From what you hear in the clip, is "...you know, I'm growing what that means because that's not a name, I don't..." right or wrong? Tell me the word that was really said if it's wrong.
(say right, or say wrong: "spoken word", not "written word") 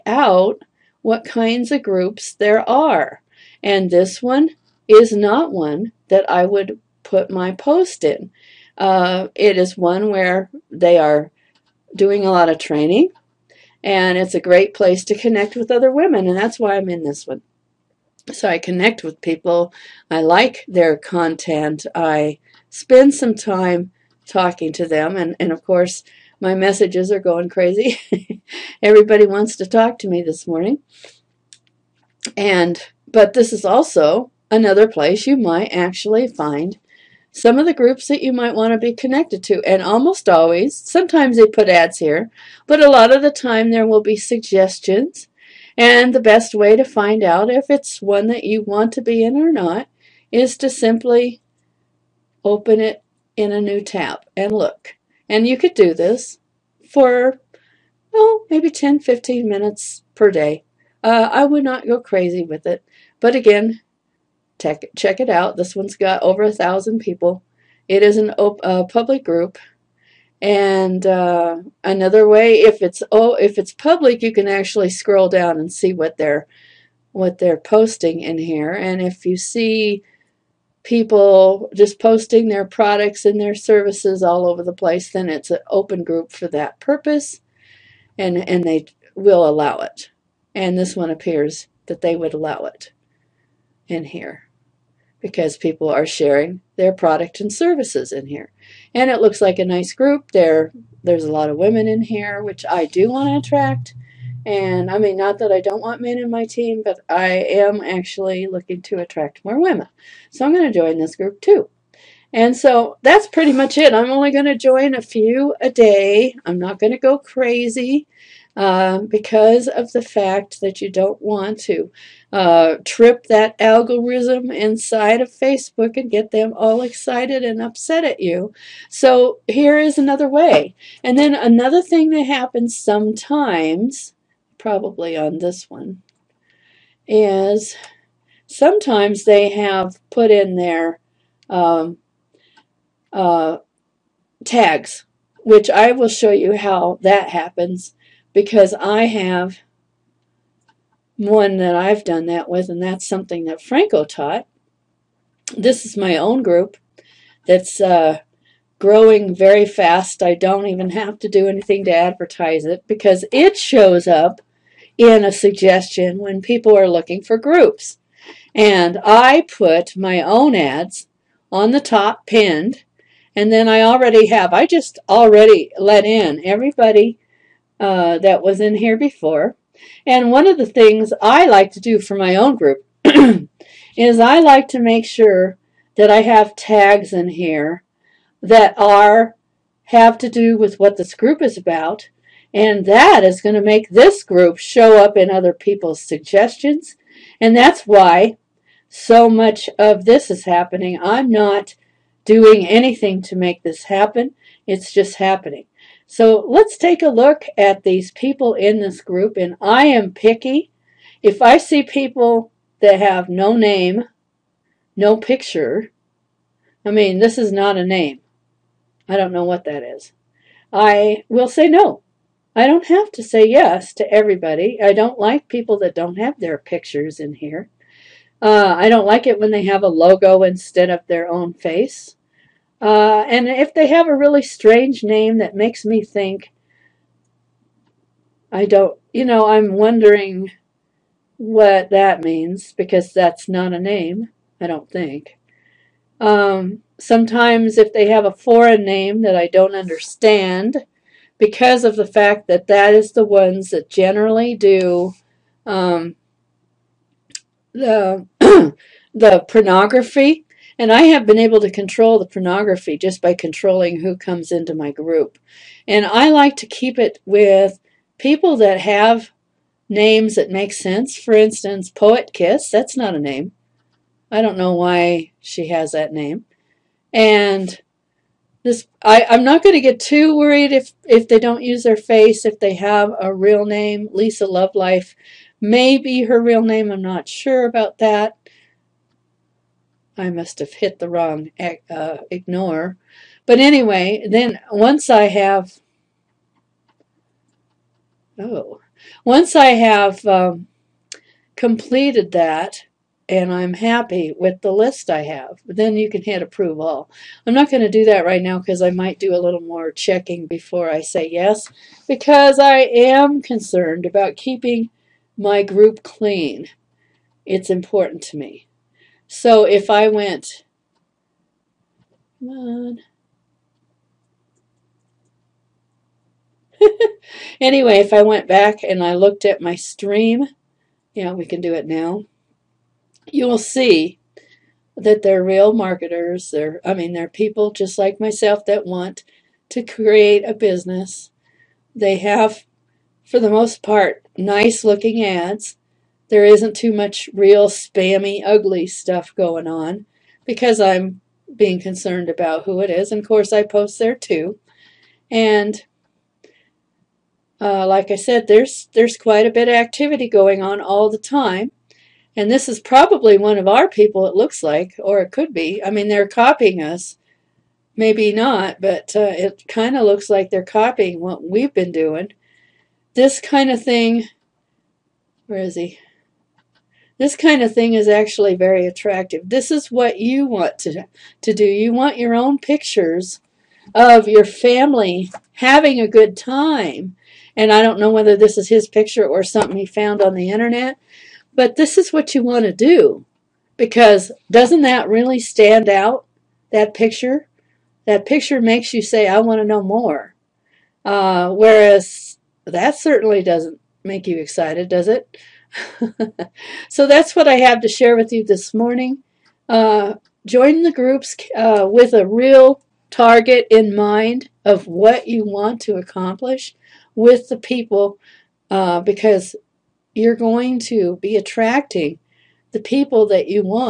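wrong: "wondering", not "growing".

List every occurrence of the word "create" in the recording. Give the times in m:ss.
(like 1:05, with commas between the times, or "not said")
5:39.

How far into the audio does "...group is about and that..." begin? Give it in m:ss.
3:11.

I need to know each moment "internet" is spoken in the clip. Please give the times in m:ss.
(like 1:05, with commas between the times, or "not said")
6:30.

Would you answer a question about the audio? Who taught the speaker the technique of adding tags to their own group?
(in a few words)
Franco.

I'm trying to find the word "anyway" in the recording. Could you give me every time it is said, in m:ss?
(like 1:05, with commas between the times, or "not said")
4:53, 5:27.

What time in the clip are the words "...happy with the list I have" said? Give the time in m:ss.
5:03.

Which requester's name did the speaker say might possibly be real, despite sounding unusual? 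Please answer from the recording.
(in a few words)
Lisa Lovelife.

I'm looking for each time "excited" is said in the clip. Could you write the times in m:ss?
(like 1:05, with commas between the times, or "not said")
2:06, 6:44.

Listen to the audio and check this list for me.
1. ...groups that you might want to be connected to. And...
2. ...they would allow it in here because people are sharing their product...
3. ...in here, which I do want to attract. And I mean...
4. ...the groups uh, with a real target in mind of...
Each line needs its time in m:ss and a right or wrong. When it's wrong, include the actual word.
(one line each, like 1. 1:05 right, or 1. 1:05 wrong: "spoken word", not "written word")
1. 0:37 right
2. 1:32 right
3. 1:41 right
4. 6:50 right.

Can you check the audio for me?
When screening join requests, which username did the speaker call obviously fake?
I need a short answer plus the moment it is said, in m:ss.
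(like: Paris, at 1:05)
Poet Kiss, at 4:31.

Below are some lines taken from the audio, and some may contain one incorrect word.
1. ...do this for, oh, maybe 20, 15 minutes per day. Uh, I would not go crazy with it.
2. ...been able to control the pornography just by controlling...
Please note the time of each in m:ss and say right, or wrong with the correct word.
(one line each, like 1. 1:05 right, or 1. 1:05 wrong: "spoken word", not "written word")
1. 0:55 wrong: "10", not "20"
2. 4:21 right.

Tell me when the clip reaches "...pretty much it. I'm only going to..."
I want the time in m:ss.
1:53.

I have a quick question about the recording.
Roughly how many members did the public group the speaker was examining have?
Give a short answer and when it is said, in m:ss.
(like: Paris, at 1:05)
over a thousand, at 1:06.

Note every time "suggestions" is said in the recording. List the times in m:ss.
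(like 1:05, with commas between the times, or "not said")
0:44, 2:45, 3:16.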